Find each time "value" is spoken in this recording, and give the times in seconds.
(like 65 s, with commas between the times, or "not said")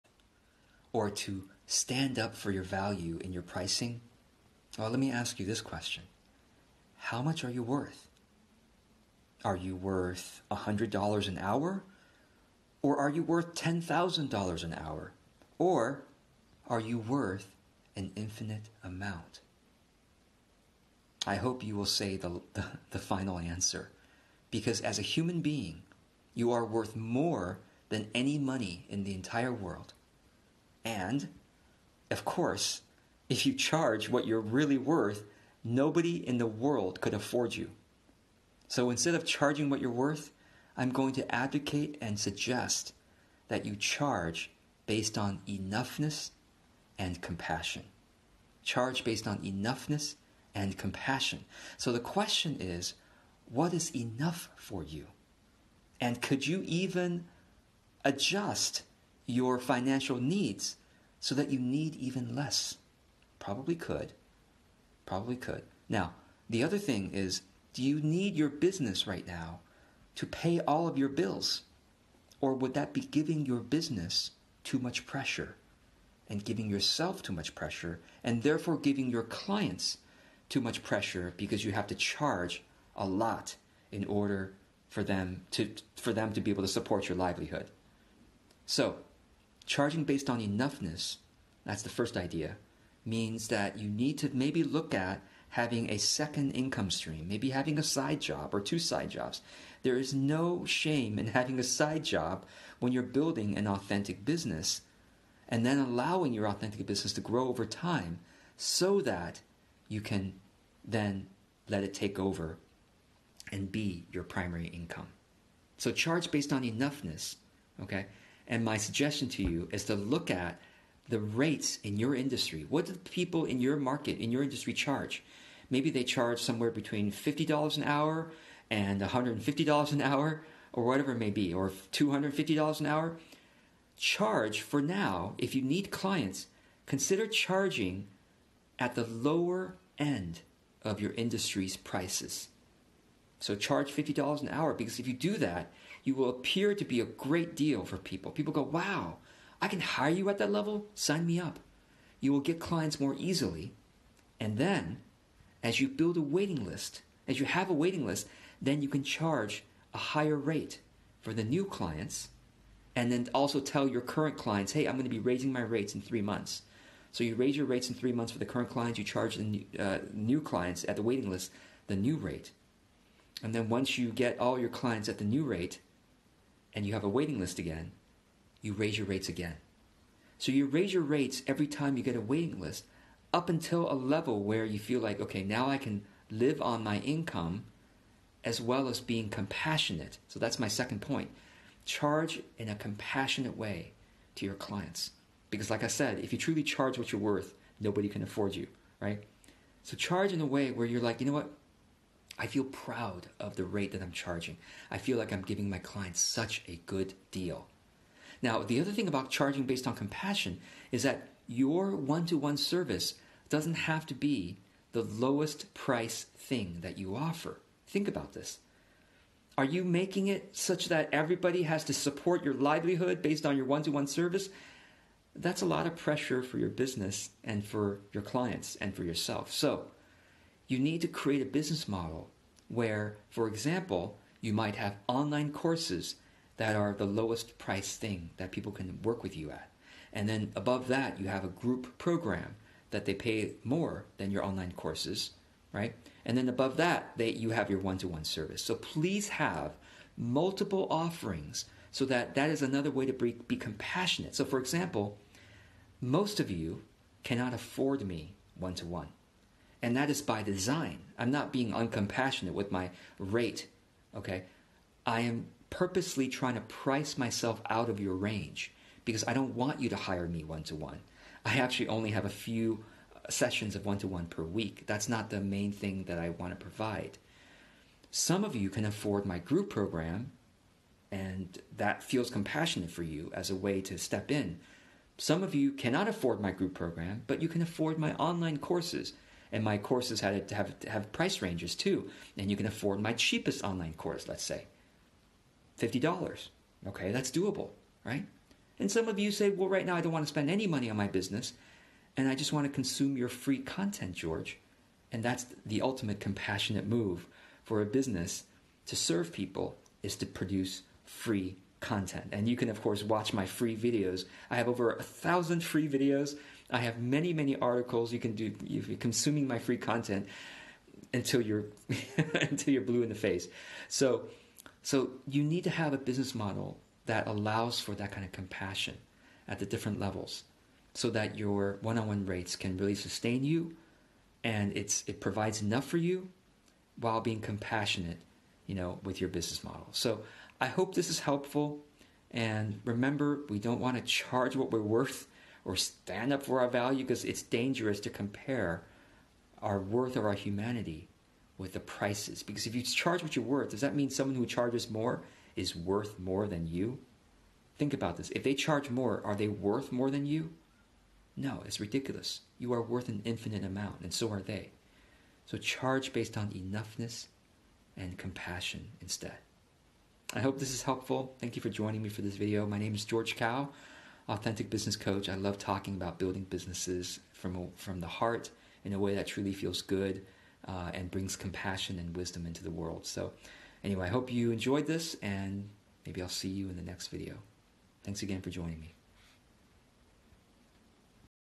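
2 s, 346 s.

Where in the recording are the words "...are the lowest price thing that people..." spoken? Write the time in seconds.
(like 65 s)
236 s.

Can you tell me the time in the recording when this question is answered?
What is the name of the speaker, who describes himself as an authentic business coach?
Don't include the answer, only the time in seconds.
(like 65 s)
373 s.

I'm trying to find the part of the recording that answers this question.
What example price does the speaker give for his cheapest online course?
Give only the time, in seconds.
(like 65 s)
295 s.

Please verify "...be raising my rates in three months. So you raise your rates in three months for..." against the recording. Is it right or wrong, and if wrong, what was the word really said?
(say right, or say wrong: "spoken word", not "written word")
right.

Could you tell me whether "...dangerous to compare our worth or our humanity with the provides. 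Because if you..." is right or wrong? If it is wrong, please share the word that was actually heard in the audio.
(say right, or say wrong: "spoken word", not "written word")
wrong: "prices", not "provides".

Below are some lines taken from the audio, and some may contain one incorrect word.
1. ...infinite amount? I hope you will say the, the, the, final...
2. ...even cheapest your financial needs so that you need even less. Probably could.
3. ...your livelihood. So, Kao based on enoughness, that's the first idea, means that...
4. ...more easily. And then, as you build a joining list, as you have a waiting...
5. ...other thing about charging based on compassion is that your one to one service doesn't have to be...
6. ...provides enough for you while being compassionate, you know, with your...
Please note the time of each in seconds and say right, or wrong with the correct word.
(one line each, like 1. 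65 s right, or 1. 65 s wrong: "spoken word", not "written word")
1. 18 s right
2. 56 s wrong: "adjust", not "cheapest"
3. 87 s wrong: "Charging", not "Kao"
4. 152 s wrong: "waiting", not "joining"
5. 208 s right
6. 335 s right.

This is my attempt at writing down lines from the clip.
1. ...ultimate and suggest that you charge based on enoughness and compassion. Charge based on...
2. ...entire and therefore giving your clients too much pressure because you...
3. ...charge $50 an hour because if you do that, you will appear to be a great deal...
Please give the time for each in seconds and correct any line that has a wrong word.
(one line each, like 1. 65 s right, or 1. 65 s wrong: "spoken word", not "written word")
1. 41 s wrong: "advocate", not "ultimate"
2. 77 s wrong: "pressure", not "entire"
3. 143 s right.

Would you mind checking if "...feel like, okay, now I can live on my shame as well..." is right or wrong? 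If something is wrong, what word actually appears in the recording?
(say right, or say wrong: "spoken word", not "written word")
wrong: "income", not "shame".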